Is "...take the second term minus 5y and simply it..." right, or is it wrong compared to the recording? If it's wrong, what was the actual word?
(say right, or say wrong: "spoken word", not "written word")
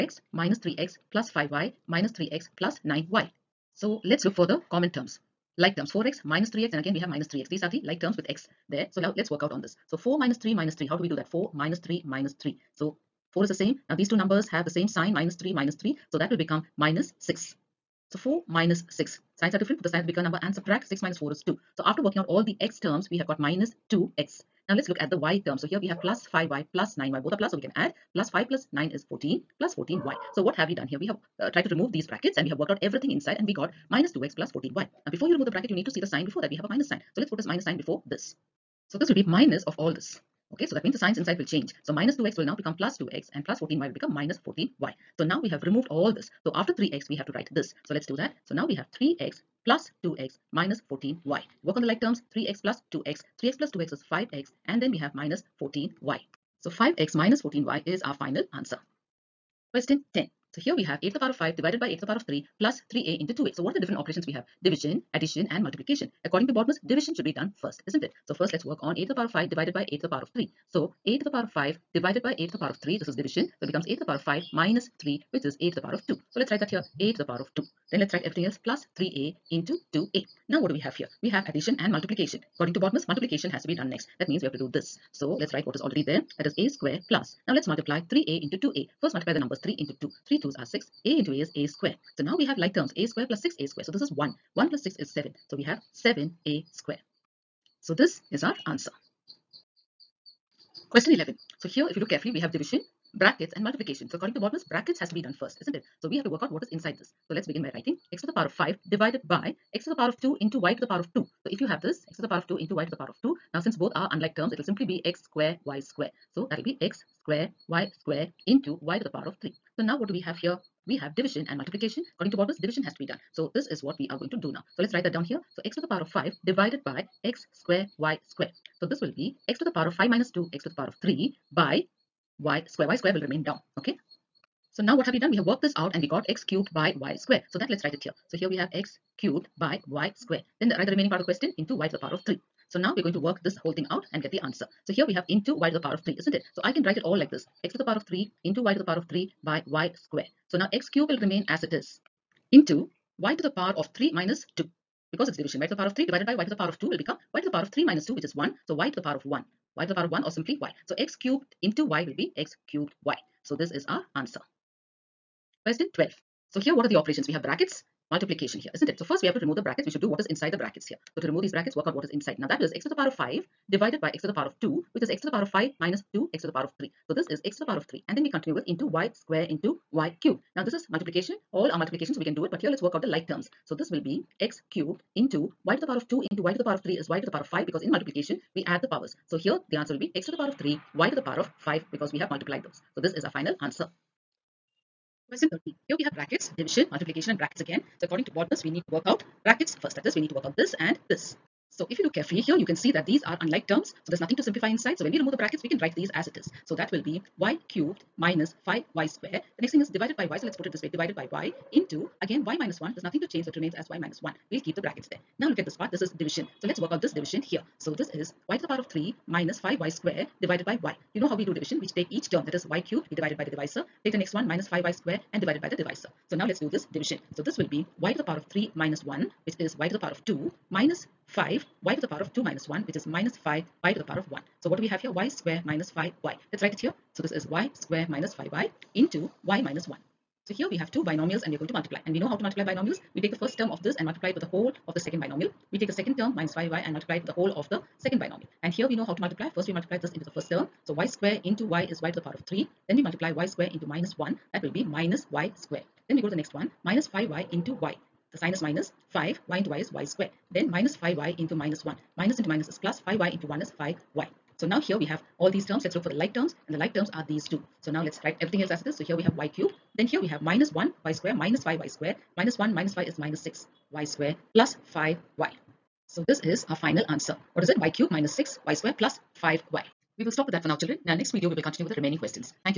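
wrong: "multiply", not "simply".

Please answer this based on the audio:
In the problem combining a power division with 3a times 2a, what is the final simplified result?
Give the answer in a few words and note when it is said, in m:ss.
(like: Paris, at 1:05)
7a², at 1:35.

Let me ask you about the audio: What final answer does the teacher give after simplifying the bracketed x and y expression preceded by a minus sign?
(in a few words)
5x - 14y.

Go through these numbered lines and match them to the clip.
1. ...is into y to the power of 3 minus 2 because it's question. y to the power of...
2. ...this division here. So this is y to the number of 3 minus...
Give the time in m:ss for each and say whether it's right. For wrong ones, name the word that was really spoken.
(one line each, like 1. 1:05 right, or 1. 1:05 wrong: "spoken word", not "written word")
1. 2:31 wrong: "division", not "question"
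2. 3:37 wrong: "power", not "number".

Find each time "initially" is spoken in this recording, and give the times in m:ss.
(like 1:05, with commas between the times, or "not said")
not said.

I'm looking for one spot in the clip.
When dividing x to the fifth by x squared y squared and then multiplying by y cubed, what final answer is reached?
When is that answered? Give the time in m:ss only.
2:42.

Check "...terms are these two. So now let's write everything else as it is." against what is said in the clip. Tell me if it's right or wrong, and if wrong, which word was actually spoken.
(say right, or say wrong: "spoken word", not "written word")
right.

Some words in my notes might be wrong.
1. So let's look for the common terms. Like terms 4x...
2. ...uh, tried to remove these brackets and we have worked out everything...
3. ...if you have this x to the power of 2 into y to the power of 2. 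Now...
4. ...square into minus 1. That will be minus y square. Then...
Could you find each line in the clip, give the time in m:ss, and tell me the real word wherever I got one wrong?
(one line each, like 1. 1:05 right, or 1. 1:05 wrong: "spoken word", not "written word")
1. 0:03 right
2. 0:31 right
3. 1:51 right
4. 4:13 right.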